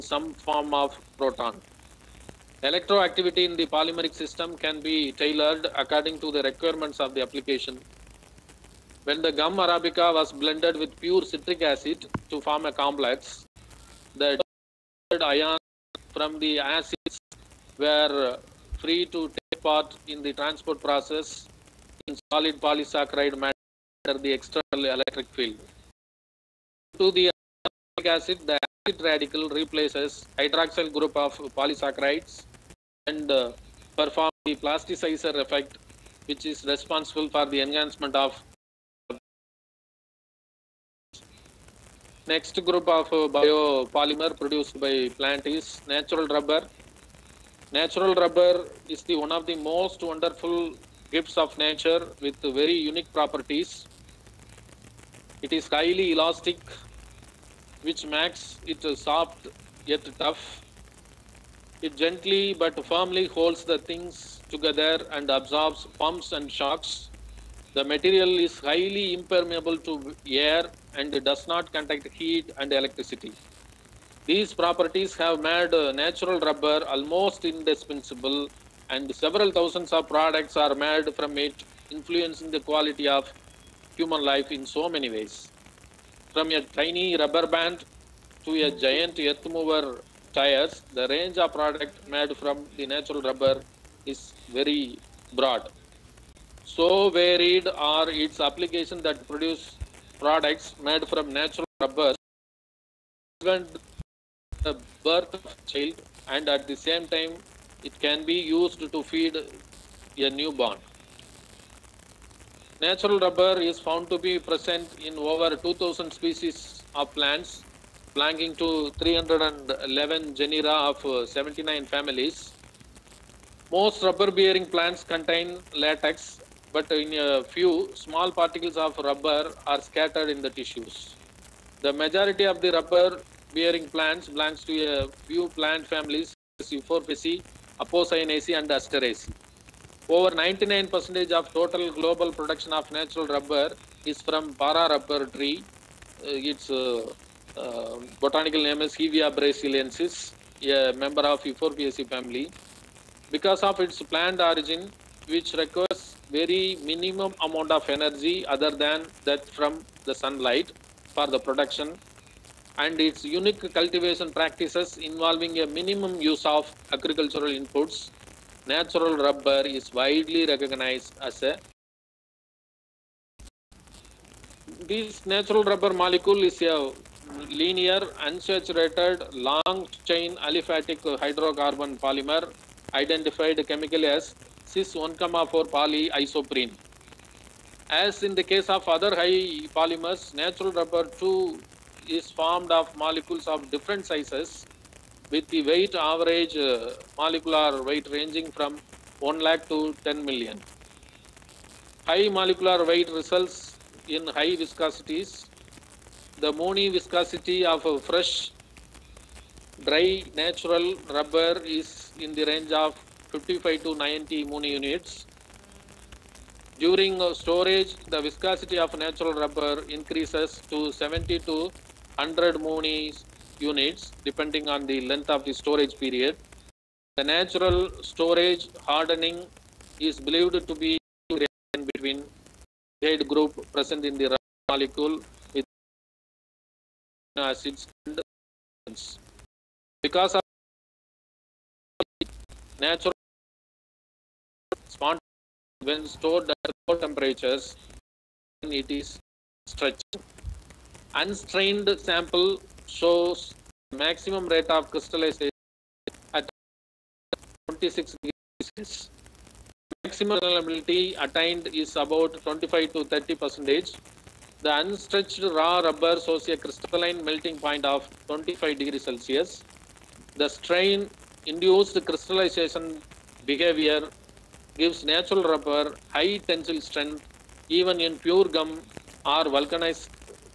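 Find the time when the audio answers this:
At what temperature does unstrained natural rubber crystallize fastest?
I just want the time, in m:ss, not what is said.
4:17.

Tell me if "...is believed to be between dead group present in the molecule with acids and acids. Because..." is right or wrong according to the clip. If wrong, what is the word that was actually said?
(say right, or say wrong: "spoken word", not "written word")
right.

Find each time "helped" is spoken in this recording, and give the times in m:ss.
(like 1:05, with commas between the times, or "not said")
not said.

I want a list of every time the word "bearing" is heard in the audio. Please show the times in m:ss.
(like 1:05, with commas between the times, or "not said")
2:04, 2:13.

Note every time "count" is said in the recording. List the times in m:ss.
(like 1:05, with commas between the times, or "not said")
not said.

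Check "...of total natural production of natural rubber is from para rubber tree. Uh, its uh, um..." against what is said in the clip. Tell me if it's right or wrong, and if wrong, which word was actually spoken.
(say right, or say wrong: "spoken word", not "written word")
wrong: "global", not "natural".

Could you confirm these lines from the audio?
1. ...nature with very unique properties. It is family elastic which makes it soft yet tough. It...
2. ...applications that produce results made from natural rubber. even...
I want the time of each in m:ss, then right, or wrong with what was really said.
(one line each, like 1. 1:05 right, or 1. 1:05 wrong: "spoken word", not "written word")
1. 0:51 wrong: "highly", not "family"
2. 1:38 wrong: "products", not "results".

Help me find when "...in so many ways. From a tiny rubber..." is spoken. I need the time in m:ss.
1:24.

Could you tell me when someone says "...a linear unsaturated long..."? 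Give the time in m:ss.
2:56.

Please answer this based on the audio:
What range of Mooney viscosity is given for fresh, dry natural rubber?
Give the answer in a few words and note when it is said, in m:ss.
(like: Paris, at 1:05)
55 to 90, at 3:33.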